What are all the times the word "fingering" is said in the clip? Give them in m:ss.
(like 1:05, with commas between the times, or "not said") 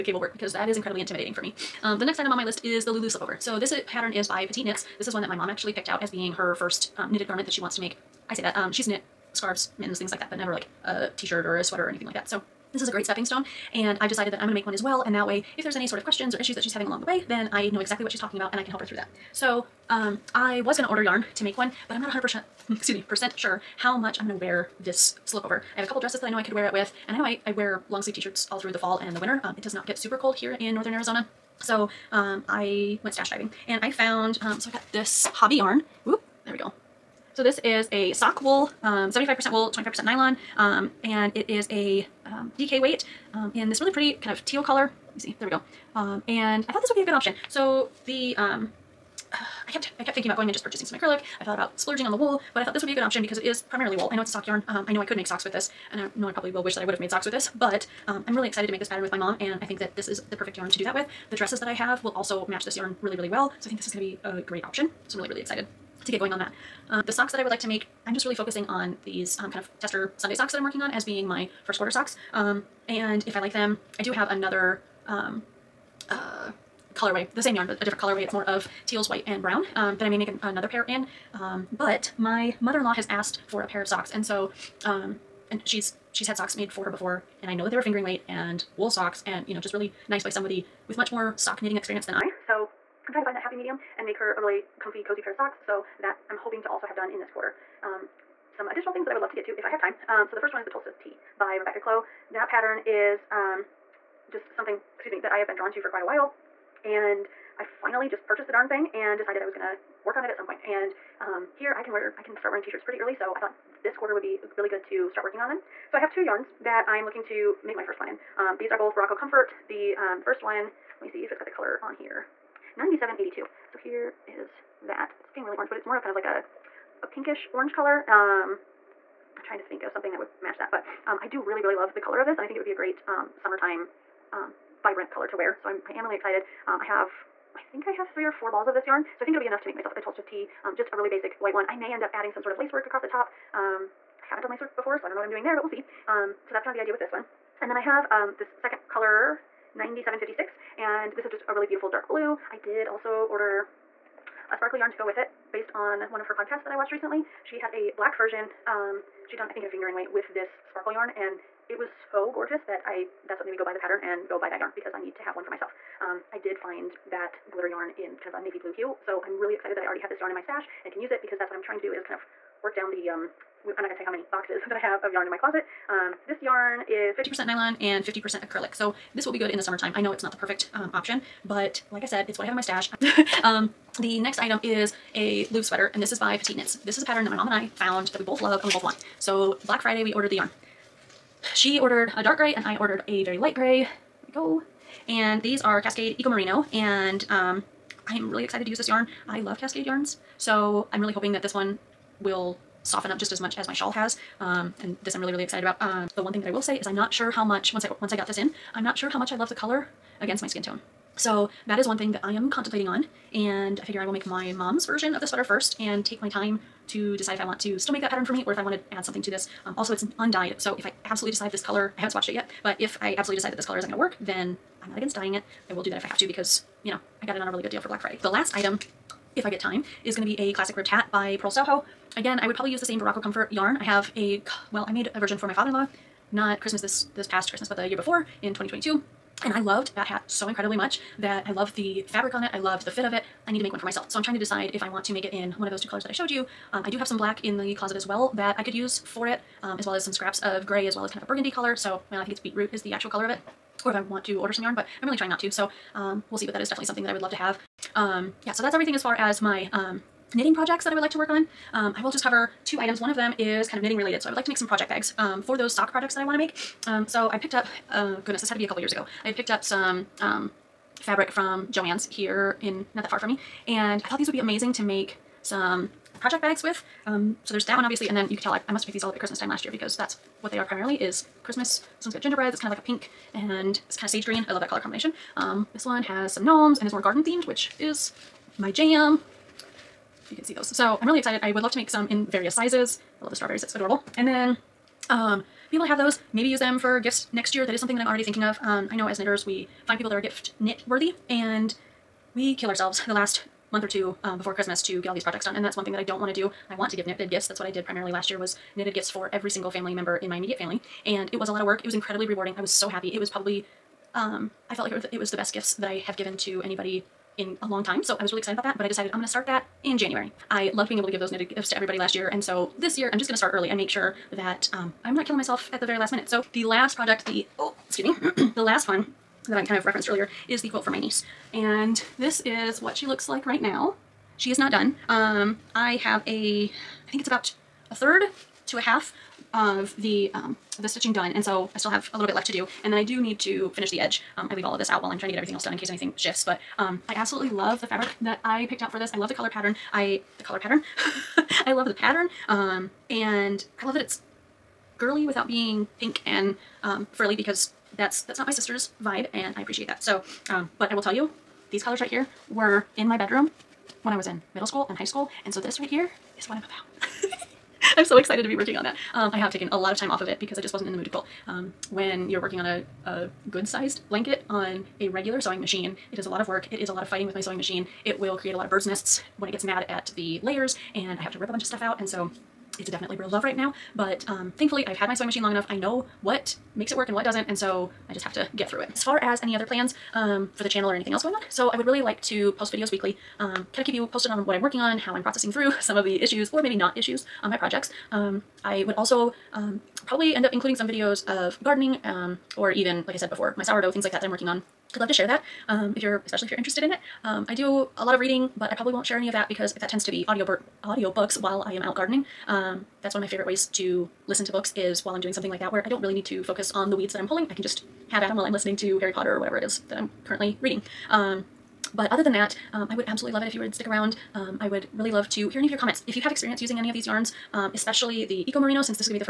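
1:27, 2:39.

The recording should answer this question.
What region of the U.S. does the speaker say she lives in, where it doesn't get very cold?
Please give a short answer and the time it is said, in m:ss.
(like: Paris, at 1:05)
Northern Arizona, at 0:30.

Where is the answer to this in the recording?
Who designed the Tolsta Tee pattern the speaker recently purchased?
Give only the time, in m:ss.
1:41.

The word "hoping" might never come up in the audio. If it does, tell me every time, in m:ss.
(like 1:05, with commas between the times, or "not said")
1:36, 3:21.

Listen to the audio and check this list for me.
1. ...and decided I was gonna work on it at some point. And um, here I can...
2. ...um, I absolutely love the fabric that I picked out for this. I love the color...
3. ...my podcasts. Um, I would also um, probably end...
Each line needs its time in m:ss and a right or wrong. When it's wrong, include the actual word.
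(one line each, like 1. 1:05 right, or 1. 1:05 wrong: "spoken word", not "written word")
1. 1:48 right
2. 5:46 right
3. 6:37 wrong: "projects", not "podcasts".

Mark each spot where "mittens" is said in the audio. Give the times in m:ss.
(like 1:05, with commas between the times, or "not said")
0:09.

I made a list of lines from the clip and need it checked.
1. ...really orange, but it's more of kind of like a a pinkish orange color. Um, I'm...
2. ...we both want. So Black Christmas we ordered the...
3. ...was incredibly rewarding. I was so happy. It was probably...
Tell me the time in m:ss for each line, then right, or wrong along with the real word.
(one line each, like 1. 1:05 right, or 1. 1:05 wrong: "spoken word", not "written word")
1. 2:05 right
2. 3:08 wrong: "Friday", not "Christmas"
3. 5:11 right.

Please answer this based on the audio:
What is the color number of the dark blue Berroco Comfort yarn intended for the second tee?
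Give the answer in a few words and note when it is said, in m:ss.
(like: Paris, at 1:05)
9756, at 2:29.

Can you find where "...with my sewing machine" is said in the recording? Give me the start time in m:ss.
6:17.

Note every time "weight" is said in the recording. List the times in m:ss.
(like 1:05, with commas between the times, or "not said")
0:42, 1:28, 2:39.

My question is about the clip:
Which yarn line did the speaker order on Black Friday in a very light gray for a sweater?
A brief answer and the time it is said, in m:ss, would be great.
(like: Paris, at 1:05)
Cascade Eco Merino, at 3:15.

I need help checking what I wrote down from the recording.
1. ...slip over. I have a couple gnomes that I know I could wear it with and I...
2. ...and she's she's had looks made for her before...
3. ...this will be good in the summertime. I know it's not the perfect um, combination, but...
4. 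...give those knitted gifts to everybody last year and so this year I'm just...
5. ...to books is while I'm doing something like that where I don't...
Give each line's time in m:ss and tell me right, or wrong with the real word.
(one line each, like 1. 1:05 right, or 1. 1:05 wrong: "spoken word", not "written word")
1. 0:25 wrong: "dresses", not "gnomes"
2. 1:25 wrong: "socks", not "looks"
3. 2:59 wrong: "option", not "combination"
4. 5:21 right
5. 6:54 right.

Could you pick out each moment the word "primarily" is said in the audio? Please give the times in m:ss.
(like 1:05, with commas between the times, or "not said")
0:53, 4:40, 5:07.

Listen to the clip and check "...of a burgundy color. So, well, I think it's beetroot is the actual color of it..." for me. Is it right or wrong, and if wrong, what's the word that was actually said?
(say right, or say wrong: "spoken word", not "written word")
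right.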